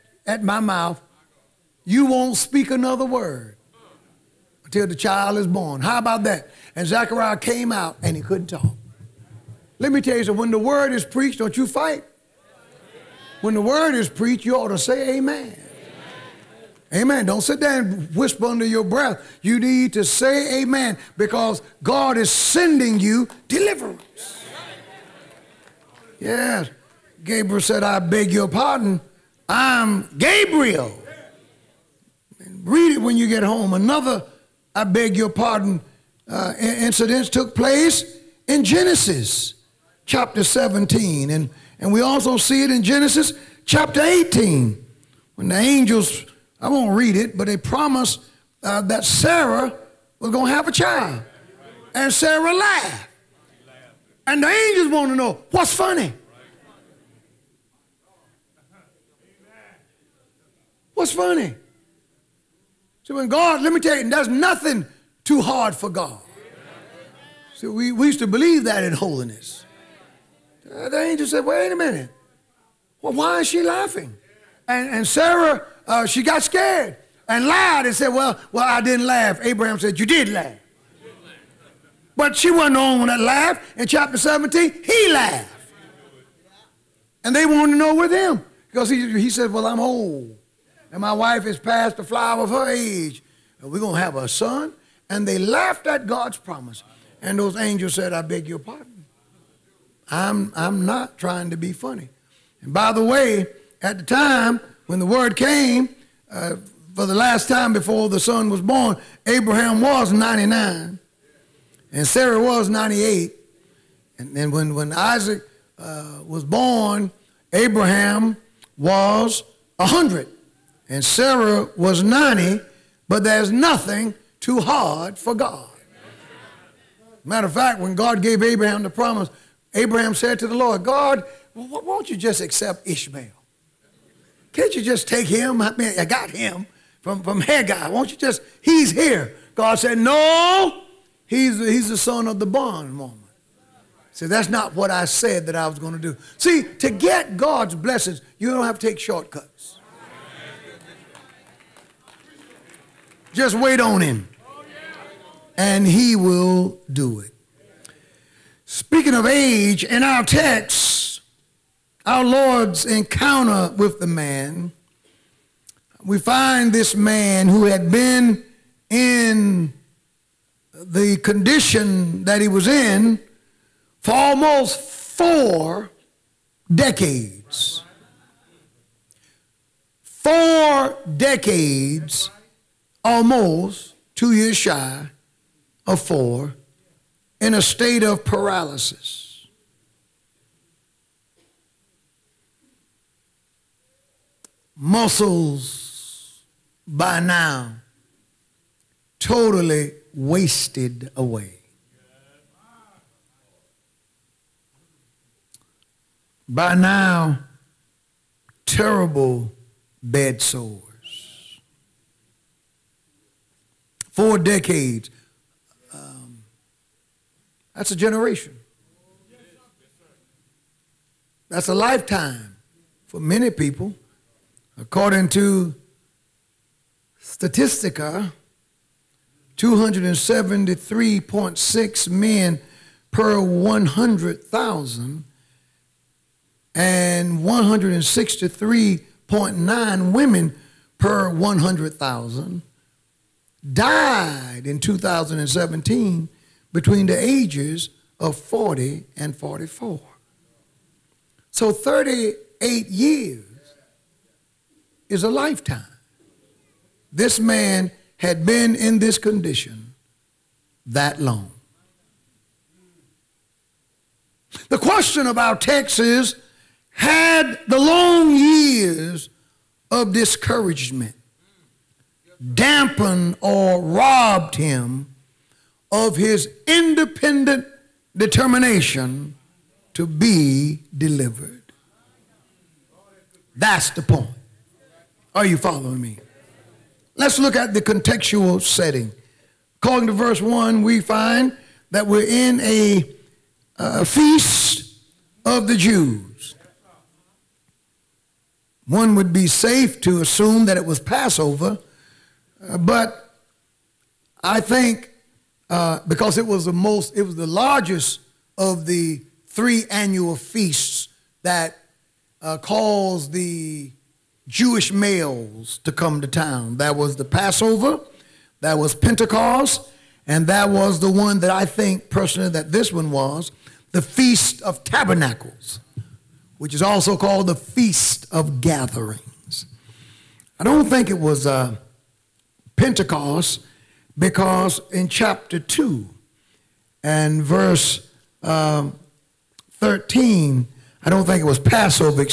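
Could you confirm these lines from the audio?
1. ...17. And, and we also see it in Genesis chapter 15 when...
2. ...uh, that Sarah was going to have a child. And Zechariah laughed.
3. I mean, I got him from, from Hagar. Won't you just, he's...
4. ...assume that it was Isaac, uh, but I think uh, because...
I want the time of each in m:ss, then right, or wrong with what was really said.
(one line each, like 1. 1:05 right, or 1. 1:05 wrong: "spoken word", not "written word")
1. 0:40 wrong: "18", not "15"
2. 0:48 wrong: "Sarah", not "Zechariah"
3. 2:15 right
4. 5:00 wrong: "Passover", not "Isaac".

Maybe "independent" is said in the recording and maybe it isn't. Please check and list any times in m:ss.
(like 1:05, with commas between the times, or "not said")
4:36.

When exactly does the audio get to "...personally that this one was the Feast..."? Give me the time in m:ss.
5:22.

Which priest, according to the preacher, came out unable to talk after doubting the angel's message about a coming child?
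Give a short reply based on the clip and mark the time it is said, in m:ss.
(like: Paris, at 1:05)
Zechariah, at 0:06.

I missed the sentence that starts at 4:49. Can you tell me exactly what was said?
According to verse 1, we find that we're in a, a feast of the Jews.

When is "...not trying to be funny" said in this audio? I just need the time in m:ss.
1:40.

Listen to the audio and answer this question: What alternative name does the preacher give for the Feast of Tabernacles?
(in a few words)
Feast of Gatherings.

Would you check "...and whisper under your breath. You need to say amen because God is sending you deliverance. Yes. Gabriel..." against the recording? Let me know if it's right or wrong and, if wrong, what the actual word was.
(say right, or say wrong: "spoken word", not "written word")
right.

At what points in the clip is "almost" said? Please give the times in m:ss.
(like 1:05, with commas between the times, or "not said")
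2:54, 3:03.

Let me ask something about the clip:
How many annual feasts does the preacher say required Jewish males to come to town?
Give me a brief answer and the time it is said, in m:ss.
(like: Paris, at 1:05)
3, at 5:09.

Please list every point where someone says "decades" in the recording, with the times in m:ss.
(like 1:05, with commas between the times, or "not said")
2:56, 3:01, 3:34.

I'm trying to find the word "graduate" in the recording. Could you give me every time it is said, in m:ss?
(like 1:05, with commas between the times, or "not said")
not said.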